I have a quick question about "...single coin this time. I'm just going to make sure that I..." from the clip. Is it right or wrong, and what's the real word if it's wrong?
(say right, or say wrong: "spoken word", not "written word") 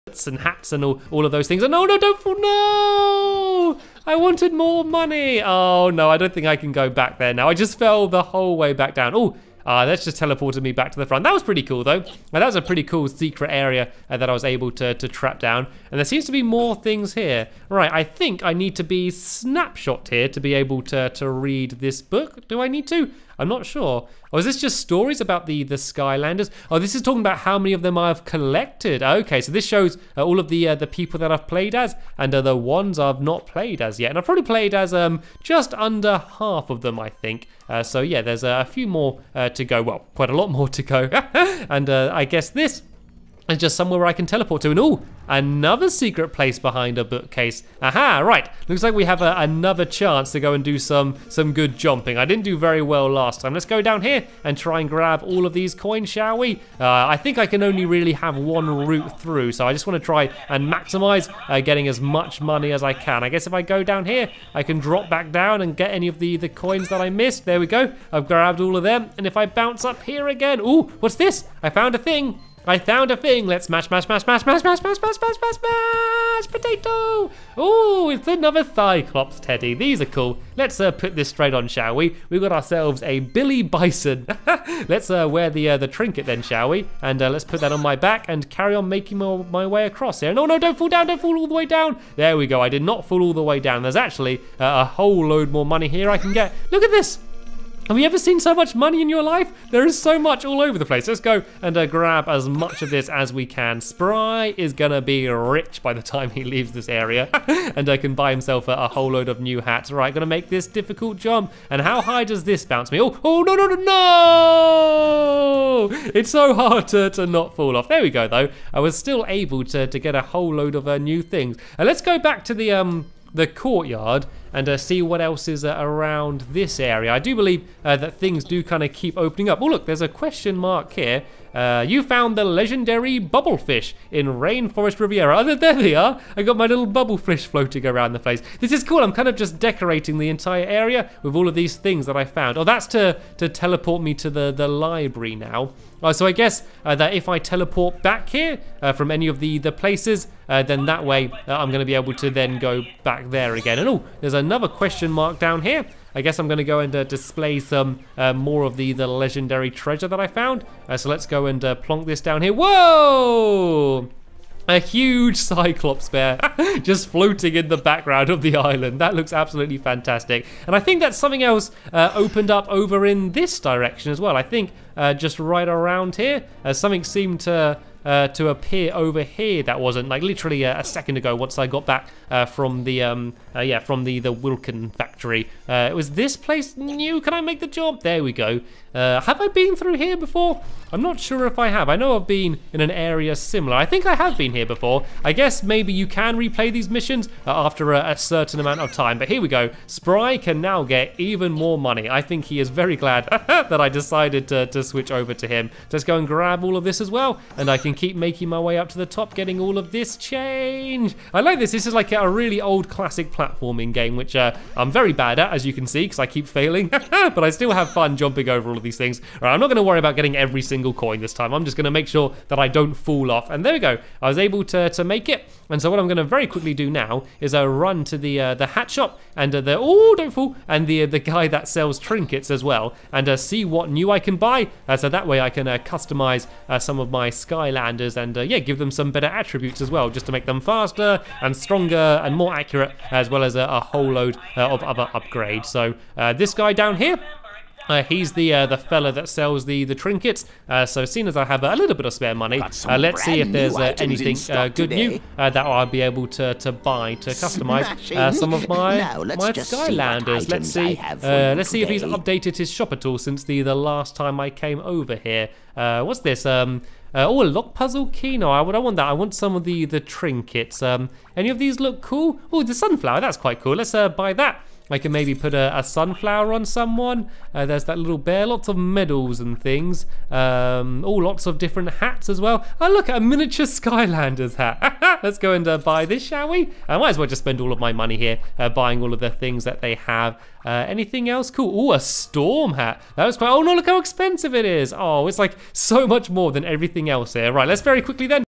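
right.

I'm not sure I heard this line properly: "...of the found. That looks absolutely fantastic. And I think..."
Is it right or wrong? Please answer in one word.
wrong.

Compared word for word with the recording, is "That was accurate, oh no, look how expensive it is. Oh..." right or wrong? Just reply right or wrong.
wrong.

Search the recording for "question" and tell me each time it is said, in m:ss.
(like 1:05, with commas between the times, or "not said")
2:10, 2:34.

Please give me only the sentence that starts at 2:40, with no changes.
Uh, so let's go and uh, plonk this down here.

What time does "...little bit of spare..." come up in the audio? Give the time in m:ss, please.
4:11.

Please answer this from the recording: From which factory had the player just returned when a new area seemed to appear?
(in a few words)
Wilkin factory.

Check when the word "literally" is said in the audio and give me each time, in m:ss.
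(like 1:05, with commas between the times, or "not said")
3:00.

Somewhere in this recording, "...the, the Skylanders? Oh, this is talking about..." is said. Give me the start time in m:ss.
0:25.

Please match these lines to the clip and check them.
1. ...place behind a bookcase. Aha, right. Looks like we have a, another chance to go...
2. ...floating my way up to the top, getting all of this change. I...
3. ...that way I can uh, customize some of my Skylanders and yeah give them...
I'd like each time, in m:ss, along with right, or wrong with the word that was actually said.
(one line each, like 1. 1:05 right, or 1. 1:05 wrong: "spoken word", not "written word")
1. 0:46 right
2. 3:28 wrong: "making", not "floating"
3. 3:55 right.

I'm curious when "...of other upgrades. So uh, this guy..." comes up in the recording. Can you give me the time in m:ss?
4:04.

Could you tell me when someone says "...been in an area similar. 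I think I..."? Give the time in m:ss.
3:12.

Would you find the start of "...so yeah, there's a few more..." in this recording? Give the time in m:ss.
0:37.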